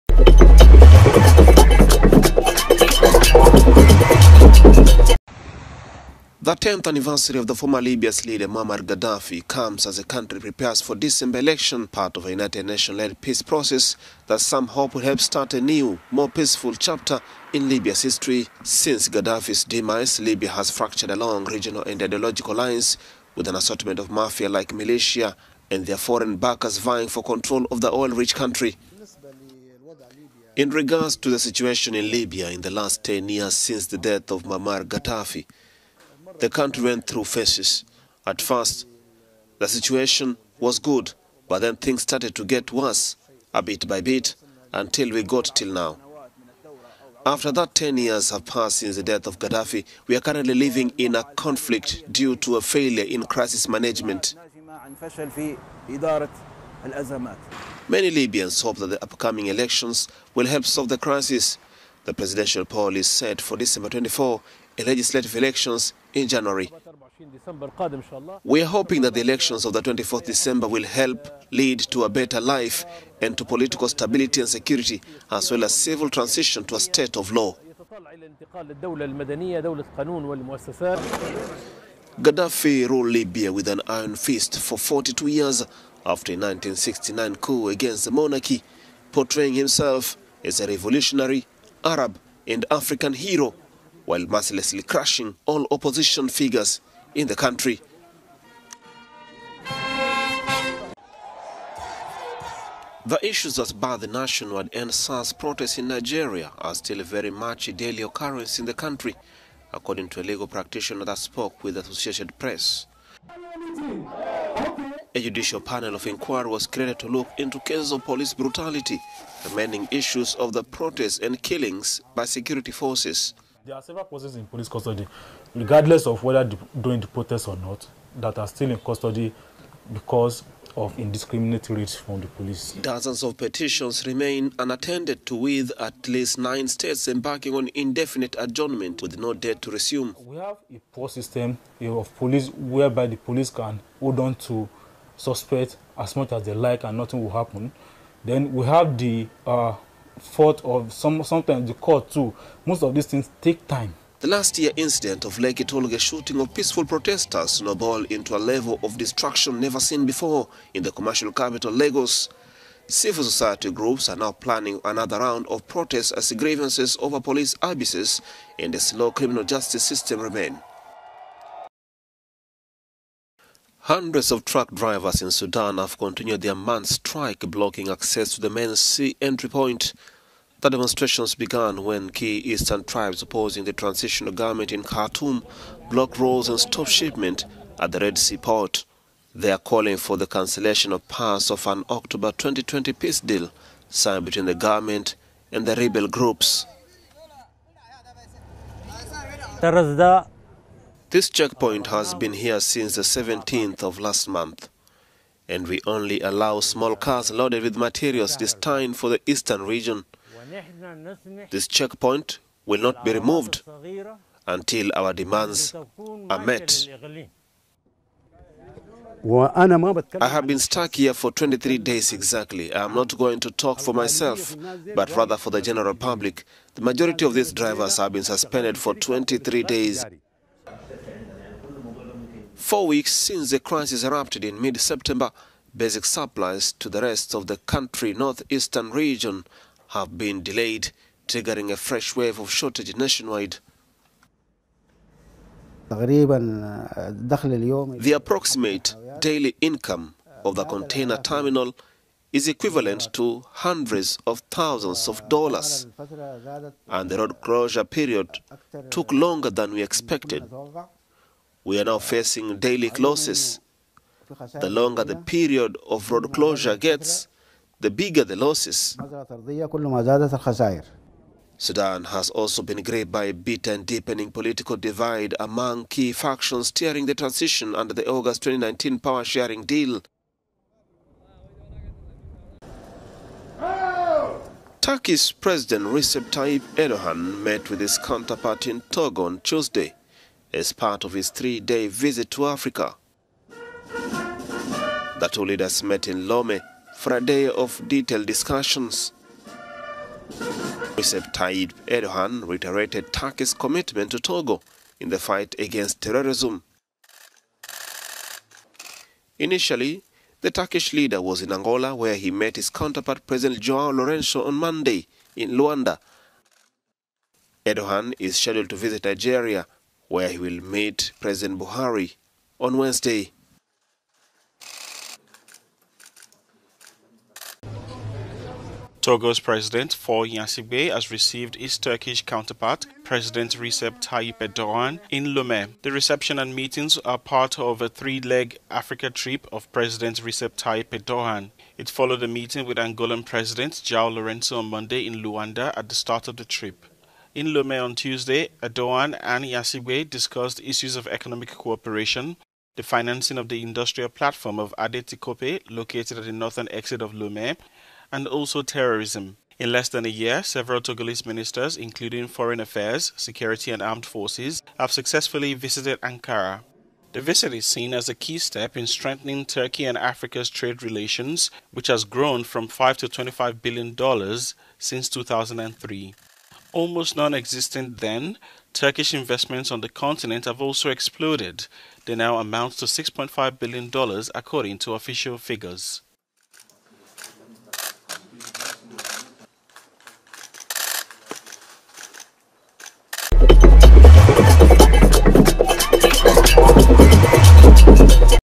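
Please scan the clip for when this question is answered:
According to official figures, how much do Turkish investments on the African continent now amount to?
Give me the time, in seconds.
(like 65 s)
382 s.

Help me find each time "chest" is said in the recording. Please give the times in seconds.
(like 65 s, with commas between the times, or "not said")
not said.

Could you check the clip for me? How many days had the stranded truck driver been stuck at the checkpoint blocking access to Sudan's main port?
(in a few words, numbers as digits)
23.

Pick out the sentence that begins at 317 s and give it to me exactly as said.
Erdogan is scheduled to visit Nigeria where he will meet President Buhari on Wednesday.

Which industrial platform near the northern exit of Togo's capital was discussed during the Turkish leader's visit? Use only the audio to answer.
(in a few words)
Adetikope.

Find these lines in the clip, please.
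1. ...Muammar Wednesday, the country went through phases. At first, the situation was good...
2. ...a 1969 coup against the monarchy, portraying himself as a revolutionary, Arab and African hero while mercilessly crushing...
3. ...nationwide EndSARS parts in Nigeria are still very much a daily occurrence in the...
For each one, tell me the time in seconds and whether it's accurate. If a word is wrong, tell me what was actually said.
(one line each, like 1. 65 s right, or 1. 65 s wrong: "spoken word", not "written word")
1. 34 s wrong: "Gaddafi", not "Wednesday"
2. 86 s right
3. 104 s wrong: "protests", not "parts".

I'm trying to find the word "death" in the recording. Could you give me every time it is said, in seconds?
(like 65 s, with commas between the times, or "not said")
33 s, 49 s.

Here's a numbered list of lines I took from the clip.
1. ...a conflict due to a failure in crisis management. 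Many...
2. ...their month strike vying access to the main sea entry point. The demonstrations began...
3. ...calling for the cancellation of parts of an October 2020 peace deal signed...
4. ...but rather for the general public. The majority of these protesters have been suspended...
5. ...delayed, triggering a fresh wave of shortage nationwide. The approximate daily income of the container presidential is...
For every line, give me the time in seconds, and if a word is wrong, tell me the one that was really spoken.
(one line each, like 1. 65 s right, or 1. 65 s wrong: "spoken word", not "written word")
1. 51 s right
2. 176 s wrong: "blocking", not "vying"
3. 189 s right
4. 224 s wrong: "drivers", not "protesters"
5. 240 s wrong: "terminal", not "presidential".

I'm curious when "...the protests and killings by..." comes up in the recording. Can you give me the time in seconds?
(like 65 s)
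120 s.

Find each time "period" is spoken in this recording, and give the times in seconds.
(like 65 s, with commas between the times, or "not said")
257 s, 265 s.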